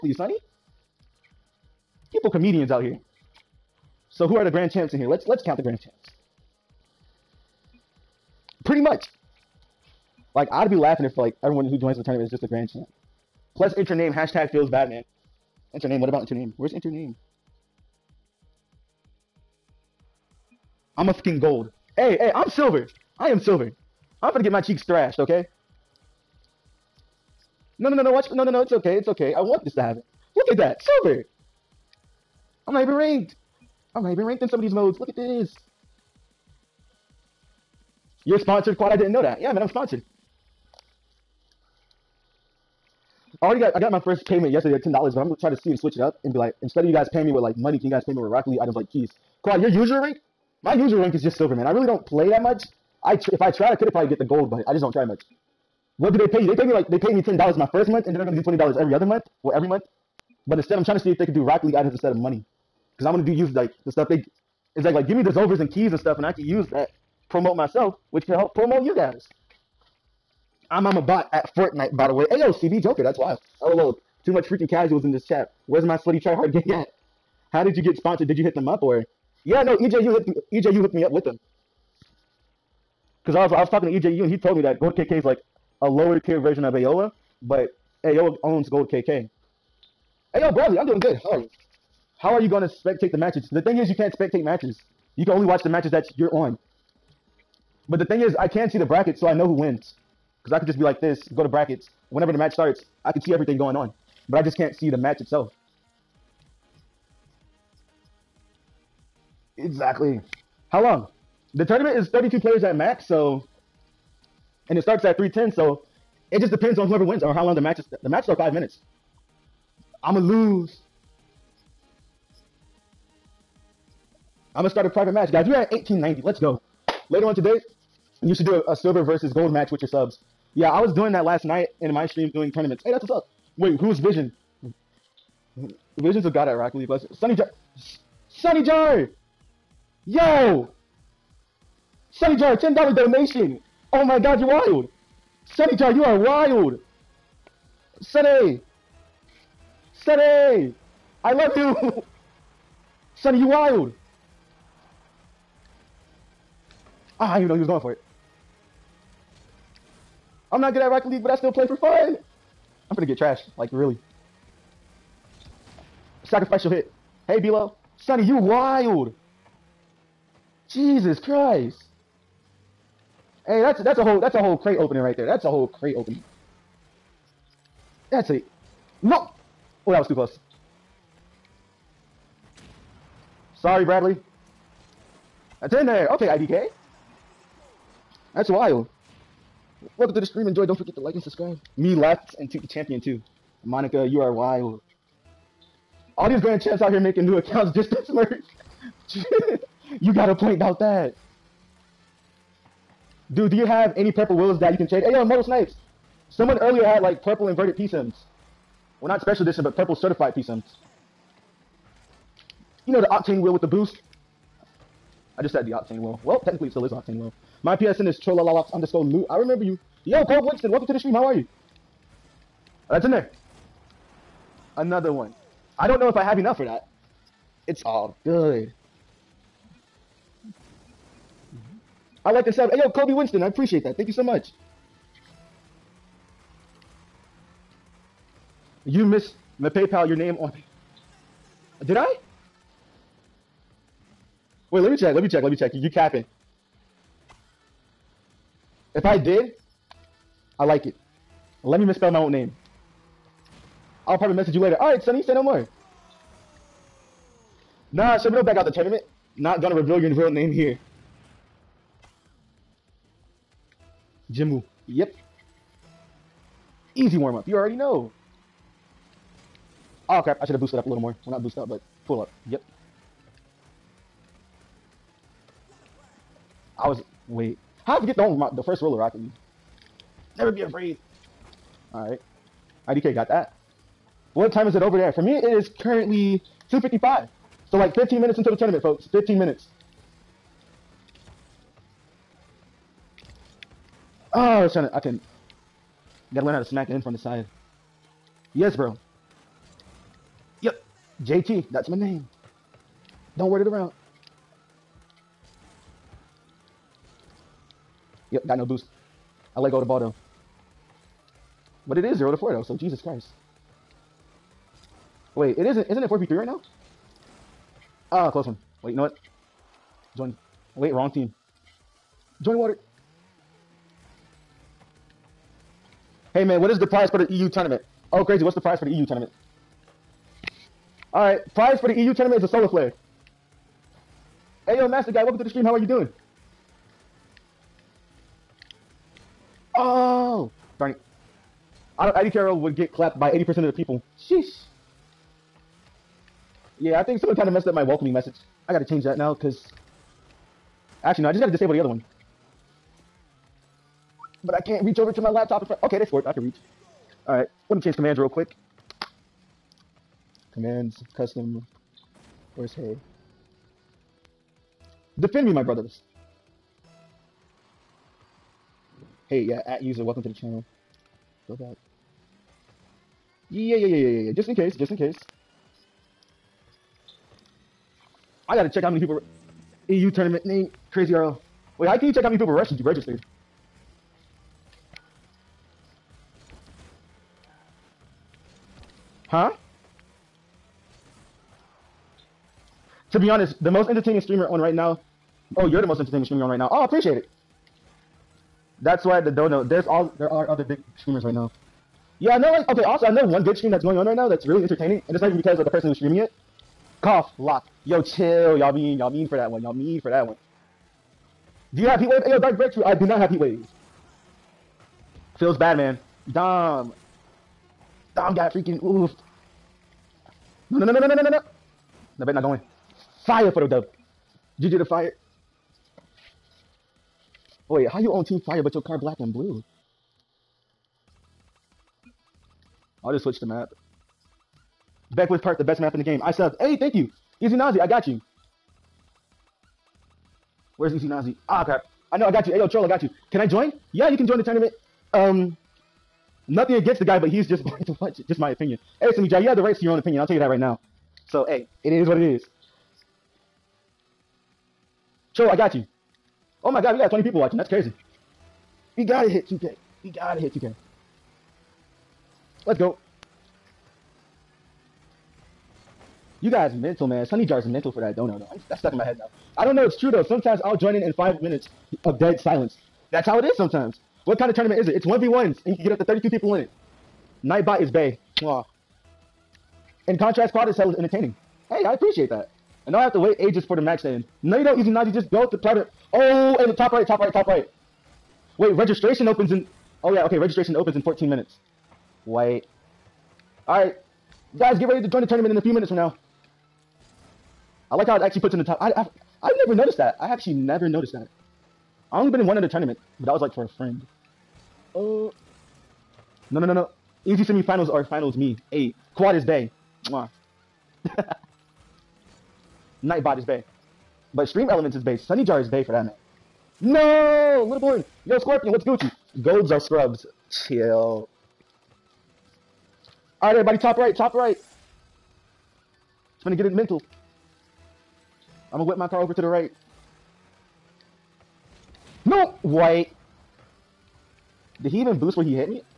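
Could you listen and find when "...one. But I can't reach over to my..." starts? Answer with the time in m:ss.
5:51.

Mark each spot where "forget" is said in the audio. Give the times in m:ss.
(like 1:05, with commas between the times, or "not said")
3:10, 4:38.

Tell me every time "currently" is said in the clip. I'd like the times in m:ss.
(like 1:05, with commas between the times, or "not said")
4:45.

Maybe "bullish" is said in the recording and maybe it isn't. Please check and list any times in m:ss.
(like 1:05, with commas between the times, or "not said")
not said.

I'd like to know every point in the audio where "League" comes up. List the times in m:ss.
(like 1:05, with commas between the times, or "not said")
0:48, 1:01, 2:16, 2:41, 4:39.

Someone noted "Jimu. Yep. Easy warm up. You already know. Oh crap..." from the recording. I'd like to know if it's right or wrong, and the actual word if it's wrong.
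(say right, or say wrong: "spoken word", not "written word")
right.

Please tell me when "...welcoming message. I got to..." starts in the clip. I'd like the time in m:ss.
5:47.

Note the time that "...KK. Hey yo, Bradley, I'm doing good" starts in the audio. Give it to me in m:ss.
1:28.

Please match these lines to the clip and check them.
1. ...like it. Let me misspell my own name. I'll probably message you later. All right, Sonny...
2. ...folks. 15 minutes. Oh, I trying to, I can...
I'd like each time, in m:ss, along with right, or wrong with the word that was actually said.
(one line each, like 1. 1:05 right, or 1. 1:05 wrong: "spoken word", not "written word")
1. 4:10 right
2. 4:48 right.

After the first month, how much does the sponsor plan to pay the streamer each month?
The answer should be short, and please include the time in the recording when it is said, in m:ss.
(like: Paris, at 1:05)
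$20, at 0:58.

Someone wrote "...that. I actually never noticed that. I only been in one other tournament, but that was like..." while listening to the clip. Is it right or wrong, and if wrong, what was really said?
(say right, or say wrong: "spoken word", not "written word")
right.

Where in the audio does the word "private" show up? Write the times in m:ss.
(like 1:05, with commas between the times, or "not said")
2:04, 8:05.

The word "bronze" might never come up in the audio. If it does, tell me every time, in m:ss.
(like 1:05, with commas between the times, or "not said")
not said.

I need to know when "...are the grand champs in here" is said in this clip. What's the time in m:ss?
0:04.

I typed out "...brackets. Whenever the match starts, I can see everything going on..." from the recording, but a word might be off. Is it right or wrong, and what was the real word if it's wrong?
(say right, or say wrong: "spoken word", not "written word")
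right.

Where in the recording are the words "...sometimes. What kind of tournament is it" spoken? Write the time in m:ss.
7:53.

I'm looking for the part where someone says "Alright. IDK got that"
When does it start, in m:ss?
4:41.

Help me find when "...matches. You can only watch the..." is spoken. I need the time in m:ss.
1:34.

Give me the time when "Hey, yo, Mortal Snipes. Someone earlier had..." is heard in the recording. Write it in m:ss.
3:25.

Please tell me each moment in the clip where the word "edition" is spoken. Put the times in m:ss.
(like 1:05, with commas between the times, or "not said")
3:29.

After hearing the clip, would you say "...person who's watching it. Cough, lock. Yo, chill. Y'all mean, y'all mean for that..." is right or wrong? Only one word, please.
wrong.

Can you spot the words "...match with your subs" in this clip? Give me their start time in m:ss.
2:09.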